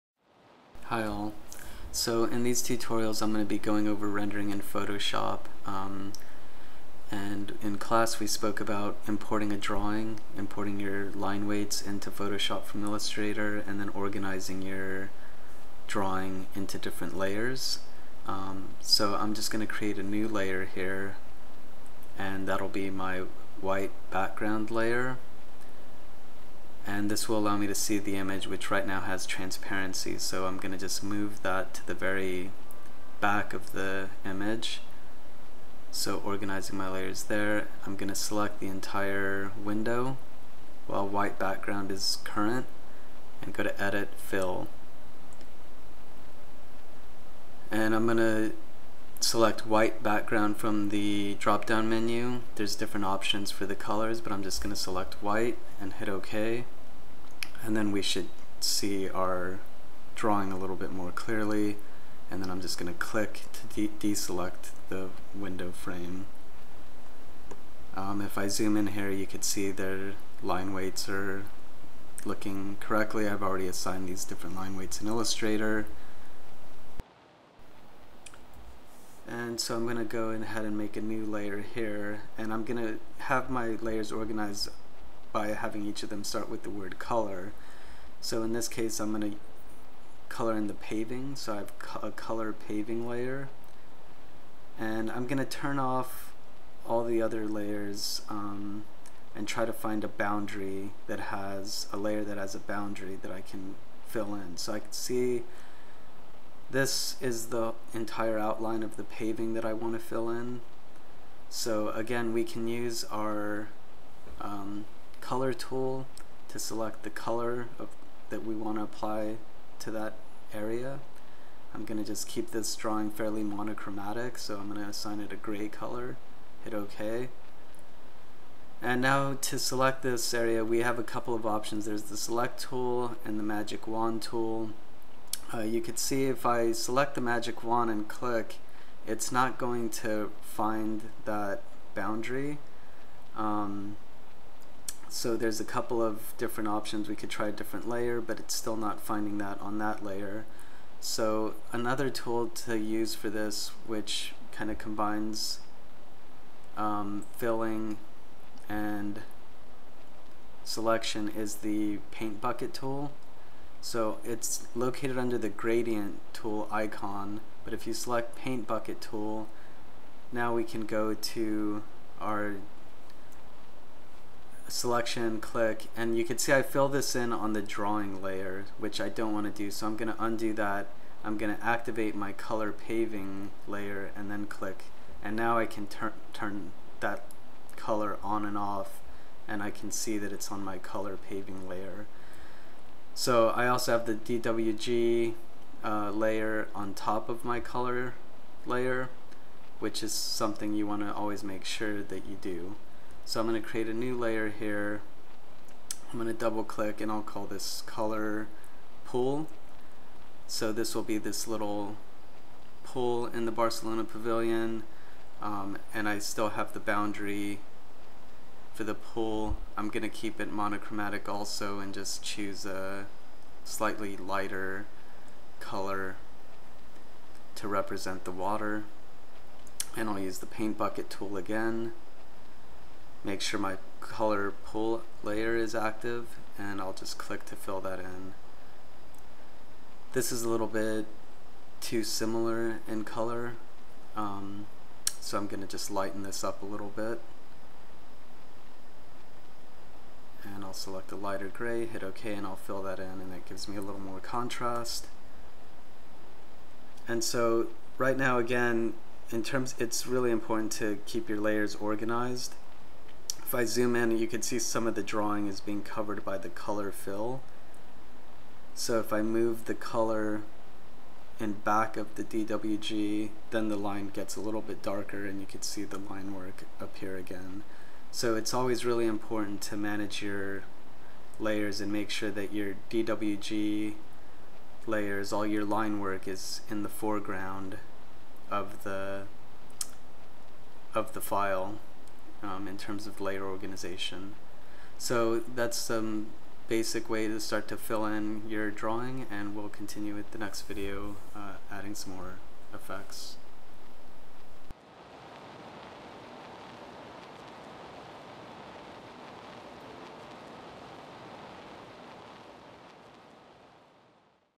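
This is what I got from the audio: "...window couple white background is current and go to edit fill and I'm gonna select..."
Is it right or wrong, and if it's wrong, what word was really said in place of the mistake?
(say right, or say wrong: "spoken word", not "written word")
wrong: "while", not "couple".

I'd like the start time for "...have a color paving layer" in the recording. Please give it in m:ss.
1:31.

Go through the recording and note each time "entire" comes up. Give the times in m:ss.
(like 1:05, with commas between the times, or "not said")
0:38, 1:47.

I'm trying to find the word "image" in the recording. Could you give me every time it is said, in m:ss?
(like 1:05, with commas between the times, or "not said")
0:28, 0:34.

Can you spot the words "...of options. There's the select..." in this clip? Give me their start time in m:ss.
2:11.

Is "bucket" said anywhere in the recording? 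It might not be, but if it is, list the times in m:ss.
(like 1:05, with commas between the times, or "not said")
2:42, 2:48, 3:50.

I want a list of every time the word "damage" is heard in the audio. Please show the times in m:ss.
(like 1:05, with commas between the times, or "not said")
not said.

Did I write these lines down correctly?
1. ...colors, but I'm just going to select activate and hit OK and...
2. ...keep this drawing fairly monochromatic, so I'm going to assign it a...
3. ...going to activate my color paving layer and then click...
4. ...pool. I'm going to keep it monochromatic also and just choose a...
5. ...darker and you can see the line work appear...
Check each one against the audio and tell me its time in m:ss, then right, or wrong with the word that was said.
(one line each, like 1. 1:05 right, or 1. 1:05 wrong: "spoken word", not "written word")
1. 0:53 wrong: "white", not "activate"
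2. 2:02 right
3. 3:01 right
4. 3:38 right
5. 4:34 right.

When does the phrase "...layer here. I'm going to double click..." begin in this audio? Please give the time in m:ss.
3:24.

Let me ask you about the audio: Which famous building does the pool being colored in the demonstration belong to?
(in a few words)
Barcelona pavilion.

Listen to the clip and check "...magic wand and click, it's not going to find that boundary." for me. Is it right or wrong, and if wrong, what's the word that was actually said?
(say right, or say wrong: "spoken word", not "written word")
right.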